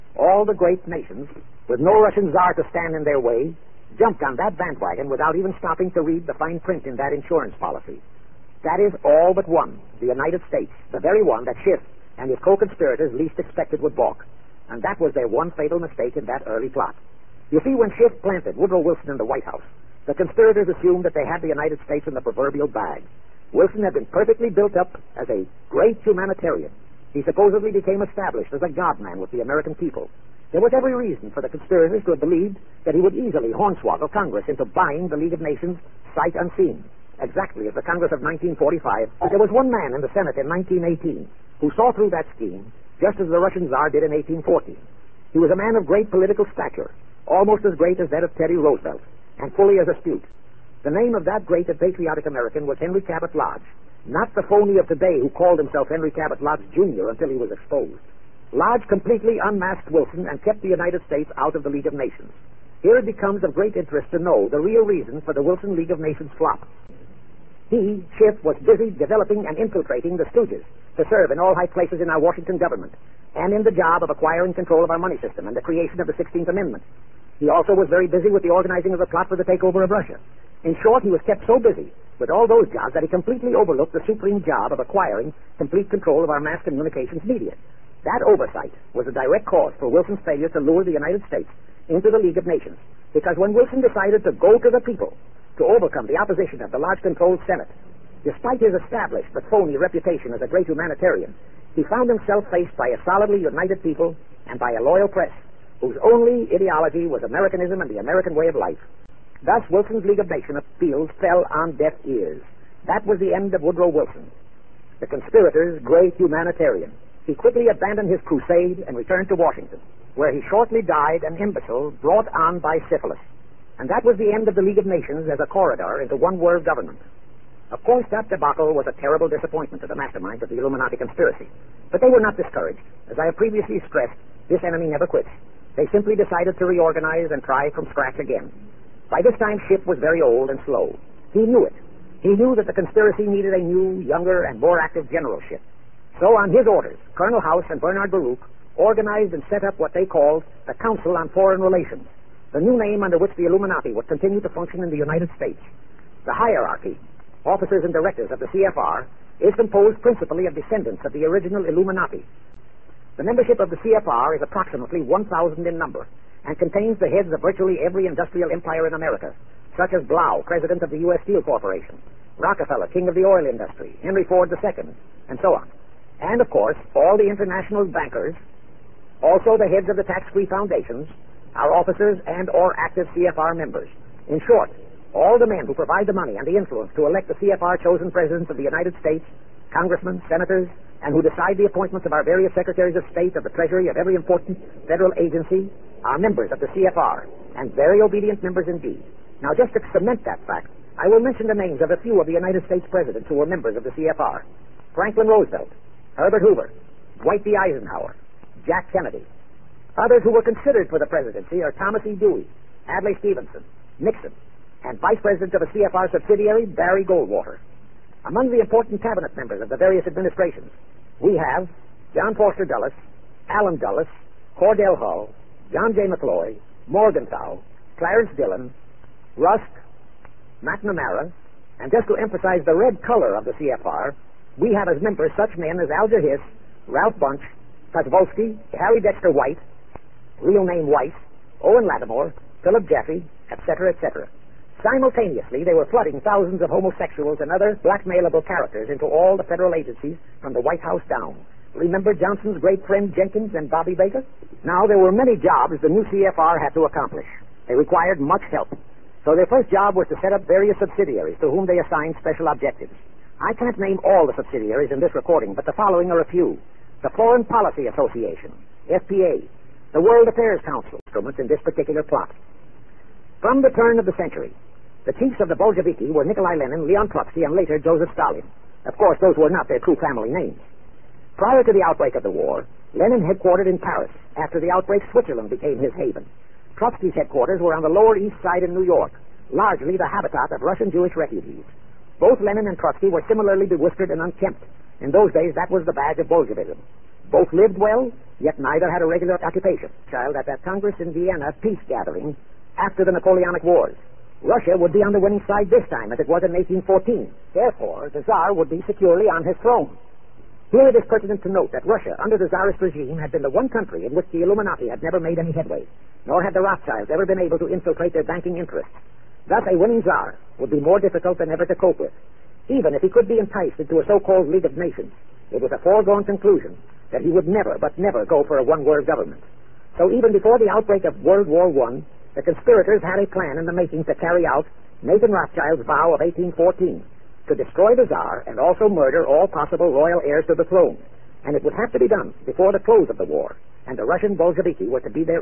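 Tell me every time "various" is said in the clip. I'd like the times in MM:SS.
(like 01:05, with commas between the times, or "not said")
03:12, 03:39, 04:20.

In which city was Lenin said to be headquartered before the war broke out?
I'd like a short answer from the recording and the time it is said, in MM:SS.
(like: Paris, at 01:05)
Paris, at 04:43.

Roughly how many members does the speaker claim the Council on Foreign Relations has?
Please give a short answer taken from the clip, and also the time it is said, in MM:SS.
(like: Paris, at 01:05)
1,000, at 02:45.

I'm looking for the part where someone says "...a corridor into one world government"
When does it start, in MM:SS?
02:05.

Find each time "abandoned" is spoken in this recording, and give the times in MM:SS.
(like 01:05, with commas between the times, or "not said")
01:57.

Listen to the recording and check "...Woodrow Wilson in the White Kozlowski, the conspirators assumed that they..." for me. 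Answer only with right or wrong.
wrong.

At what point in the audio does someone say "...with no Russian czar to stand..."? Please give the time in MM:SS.
00:01.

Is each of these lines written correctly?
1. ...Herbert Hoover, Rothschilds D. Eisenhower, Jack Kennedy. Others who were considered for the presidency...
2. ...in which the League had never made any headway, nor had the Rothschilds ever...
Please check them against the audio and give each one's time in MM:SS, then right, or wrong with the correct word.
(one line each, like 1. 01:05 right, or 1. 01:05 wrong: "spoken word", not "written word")
1. 03:26 wrong: "Dwight", not "Rothschilds"
2. 05:14 wrong: "Illuminati", not "League".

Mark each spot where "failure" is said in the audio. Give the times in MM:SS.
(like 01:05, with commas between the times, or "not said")
01:30.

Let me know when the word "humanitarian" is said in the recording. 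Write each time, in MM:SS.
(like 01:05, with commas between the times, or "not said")
00:26, 01:40, 01:56.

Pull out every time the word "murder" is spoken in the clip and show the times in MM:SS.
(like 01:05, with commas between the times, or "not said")
05:38.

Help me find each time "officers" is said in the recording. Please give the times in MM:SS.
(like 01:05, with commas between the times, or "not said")
02:37, 03:01.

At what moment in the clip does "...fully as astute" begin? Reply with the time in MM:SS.
00:49.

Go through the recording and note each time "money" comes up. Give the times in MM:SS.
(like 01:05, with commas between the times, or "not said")
01:14, 03:06.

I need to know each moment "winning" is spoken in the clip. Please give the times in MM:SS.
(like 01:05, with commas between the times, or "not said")
05:05, 05:19.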